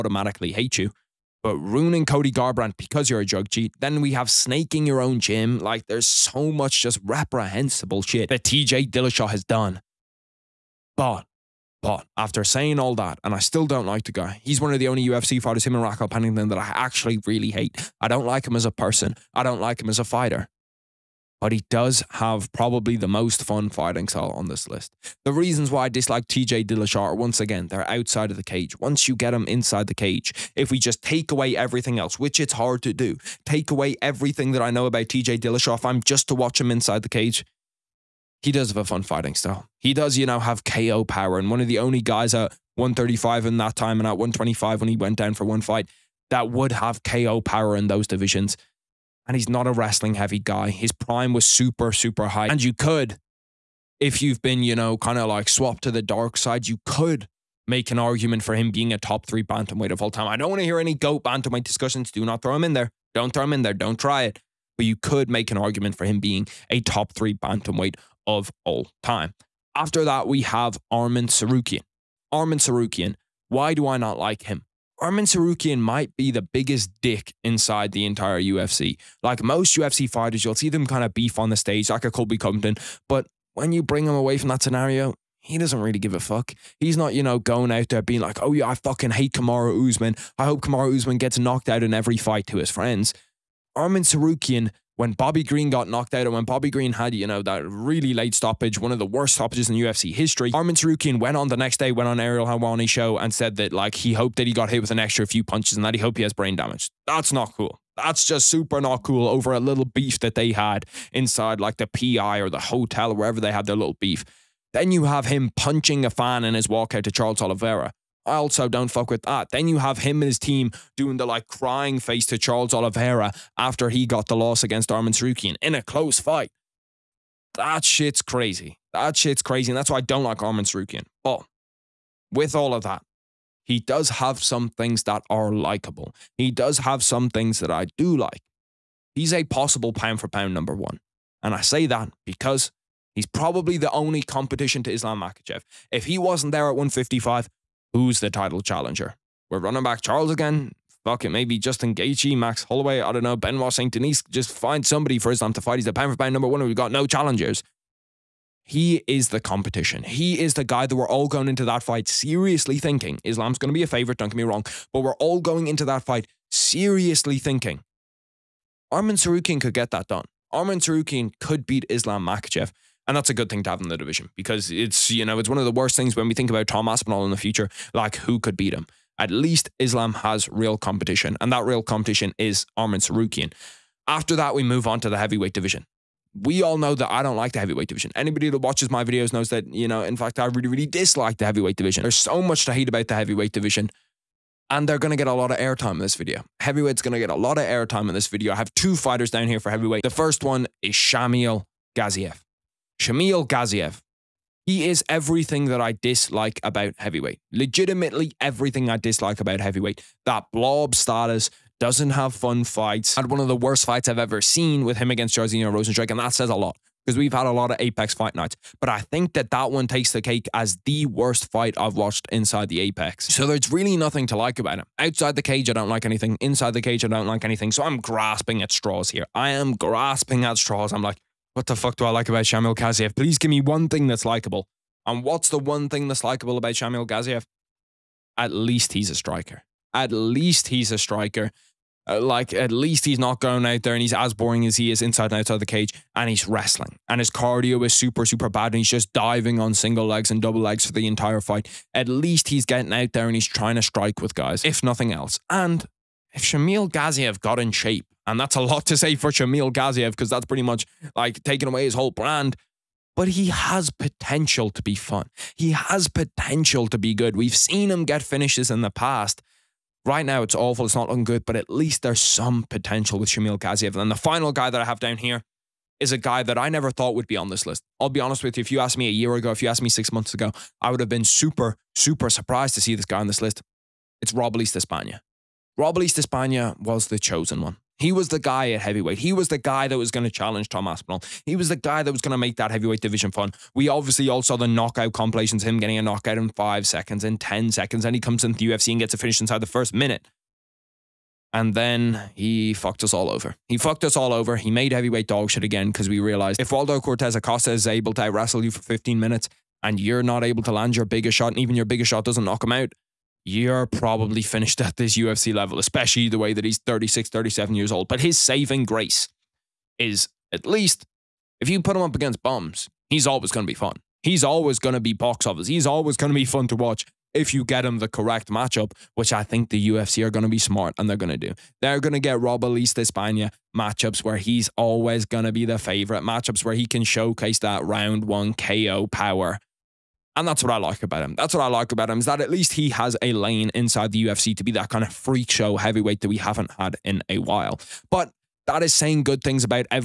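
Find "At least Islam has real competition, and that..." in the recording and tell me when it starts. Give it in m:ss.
2:59.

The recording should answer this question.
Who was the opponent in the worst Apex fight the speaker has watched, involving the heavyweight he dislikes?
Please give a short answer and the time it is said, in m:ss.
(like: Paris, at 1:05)
Jairzinho Rozenstruik, at 3:35.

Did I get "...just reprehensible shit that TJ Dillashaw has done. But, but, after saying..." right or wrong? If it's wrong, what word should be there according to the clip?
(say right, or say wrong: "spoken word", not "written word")
right.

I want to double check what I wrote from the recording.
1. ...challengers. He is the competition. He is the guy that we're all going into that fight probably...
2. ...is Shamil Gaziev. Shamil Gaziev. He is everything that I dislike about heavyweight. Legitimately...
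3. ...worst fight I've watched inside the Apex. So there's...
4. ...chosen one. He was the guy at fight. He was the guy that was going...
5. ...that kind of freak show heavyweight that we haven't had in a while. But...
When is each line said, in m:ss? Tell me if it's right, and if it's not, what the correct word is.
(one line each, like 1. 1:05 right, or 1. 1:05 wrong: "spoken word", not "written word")
1. 2:37 wrong: "seriously", not "probably"
2. 3:20 right
3. 3:41 right
4. 4:47 wrong: "heavyweight", not "fight"
5. 5:44 right.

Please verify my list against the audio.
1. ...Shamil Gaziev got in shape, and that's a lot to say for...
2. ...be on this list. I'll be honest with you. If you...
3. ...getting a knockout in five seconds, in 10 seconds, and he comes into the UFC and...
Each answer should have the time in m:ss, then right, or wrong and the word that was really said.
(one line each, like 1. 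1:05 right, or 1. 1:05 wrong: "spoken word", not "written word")
1. 4:16 right
2. 4:37 right
3. 4:55 right.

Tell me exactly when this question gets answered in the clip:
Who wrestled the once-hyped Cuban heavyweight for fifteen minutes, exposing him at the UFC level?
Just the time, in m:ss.
5:06.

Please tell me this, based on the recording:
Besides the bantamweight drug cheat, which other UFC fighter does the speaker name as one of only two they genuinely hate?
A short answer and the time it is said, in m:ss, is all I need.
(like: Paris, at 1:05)
Raquel Pennington, at 0:15.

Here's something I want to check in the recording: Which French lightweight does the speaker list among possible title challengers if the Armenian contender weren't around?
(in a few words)
Benoit St. Denis.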